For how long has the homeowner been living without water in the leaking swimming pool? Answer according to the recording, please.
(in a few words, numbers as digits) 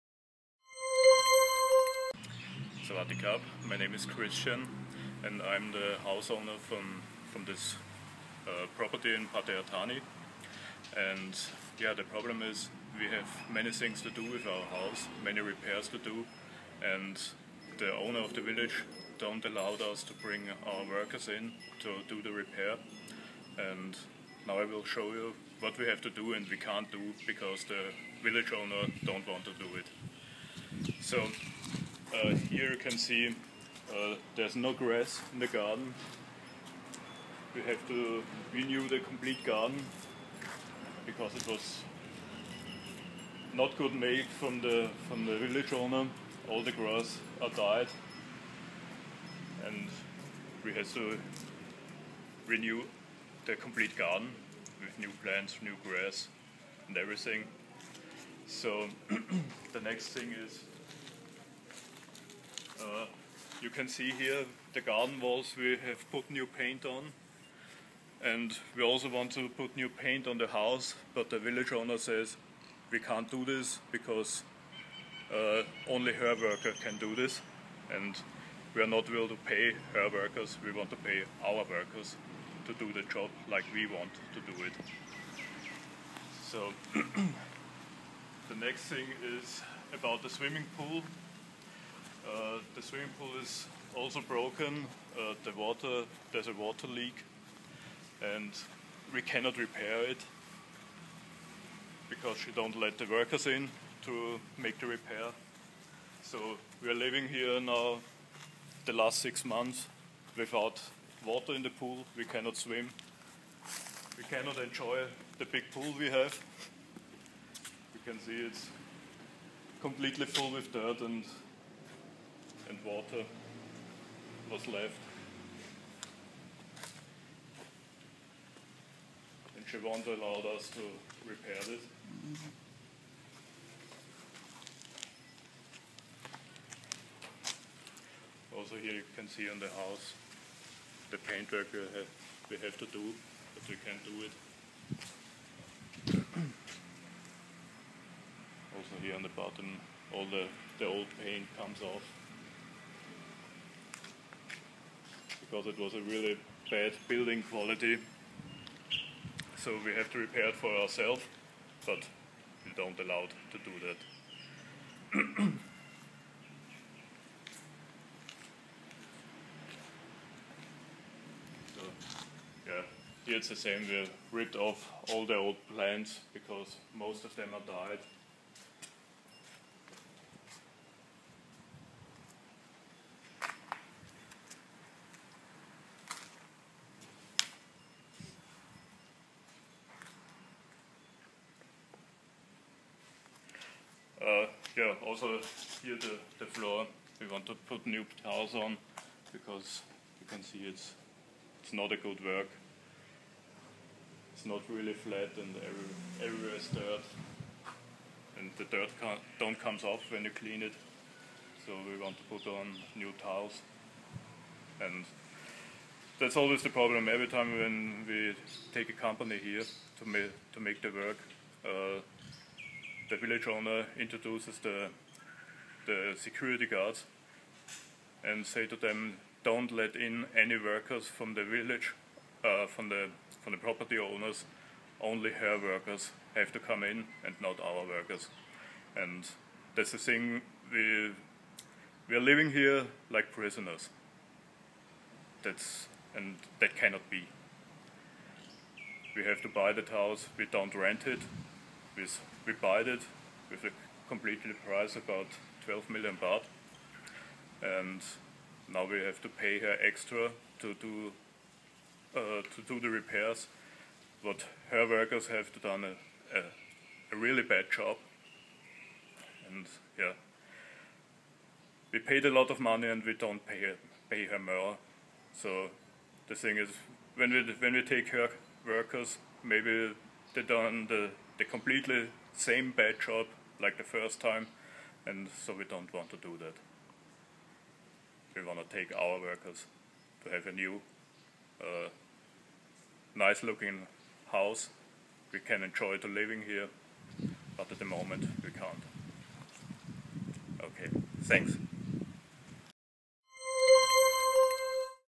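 6 months.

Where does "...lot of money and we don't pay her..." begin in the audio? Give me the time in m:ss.
4:32.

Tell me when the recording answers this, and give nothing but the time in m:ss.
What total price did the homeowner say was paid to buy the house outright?
4:15.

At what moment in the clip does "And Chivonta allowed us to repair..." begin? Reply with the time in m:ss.
2:09.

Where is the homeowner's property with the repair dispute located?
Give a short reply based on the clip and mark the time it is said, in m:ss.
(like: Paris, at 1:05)
Pattaya Thanee, at 0:09.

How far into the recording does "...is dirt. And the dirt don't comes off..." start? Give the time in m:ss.
3:26.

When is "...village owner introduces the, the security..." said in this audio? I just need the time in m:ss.
3:43.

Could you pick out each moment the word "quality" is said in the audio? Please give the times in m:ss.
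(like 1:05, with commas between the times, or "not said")
2:37.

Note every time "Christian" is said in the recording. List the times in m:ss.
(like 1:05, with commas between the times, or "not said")
0:04.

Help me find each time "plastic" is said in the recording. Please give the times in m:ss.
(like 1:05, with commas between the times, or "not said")
not said.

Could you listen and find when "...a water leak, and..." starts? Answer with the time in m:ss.
1:36.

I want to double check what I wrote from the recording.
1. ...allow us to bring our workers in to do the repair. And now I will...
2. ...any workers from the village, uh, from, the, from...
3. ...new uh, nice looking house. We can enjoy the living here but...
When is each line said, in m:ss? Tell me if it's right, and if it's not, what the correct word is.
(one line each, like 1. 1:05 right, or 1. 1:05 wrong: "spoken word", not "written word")
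1. 0:19 right
2. 3:50 right
3. 4:50 right.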